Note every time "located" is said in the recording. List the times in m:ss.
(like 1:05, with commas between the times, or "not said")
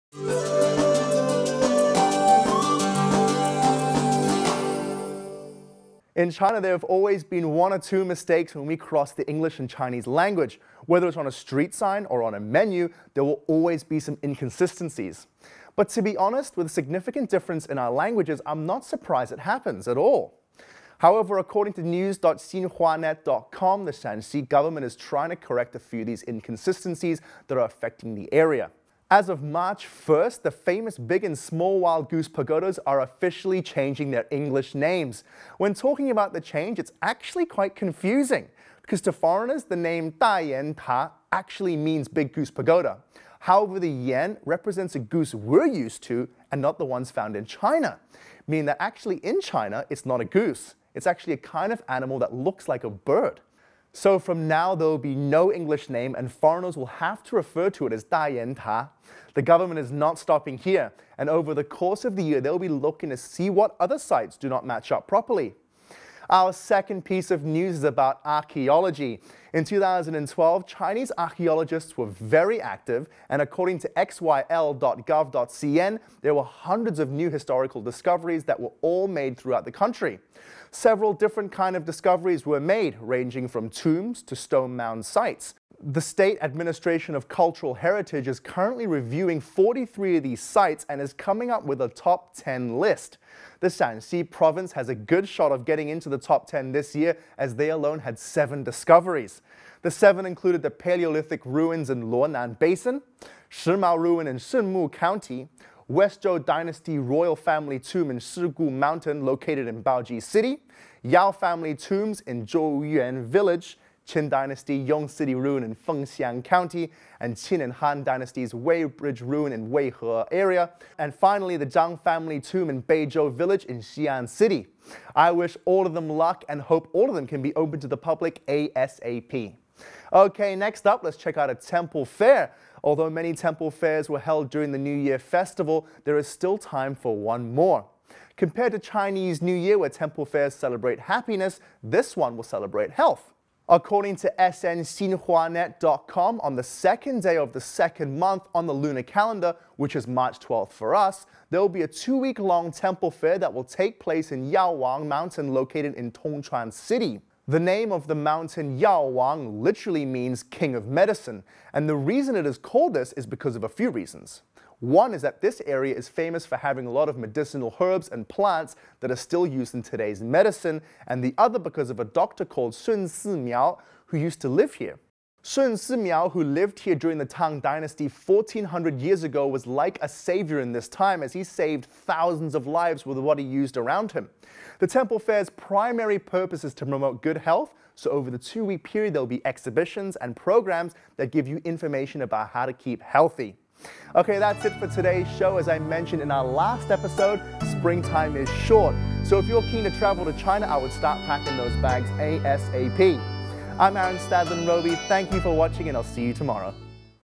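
1:49, 2:35.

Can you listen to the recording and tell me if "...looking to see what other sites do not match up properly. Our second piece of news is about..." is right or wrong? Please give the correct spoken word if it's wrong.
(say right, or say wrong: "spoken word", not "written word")
right.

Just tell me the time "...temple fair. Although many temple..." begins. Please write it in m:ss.
2:11.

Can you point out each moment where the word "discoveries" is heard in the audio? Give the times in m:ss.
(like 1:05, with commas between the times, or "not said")
1:17, 1:21, 1:38.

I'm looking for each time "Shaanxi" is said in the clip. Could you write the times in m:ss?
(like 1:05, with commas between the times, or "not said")
0:23, 1:33.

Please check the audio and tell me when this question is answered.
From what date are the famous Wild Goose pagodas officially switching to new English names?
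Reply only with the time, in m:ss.
0:29.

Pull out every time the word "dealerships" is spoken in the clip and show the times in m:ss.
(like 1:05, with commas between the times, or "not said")
not said.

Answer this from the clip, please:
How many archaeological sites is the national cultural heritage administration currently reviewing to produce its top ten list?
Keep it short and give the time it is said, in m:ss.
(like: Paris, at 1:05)
43, at 1:29.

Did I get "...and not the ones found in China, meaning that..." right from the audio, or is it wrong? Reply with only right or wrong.
right.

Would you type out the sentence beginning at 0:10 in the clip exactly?
Whether it's on a street sign or on a menu, there will always be some inconsistencies.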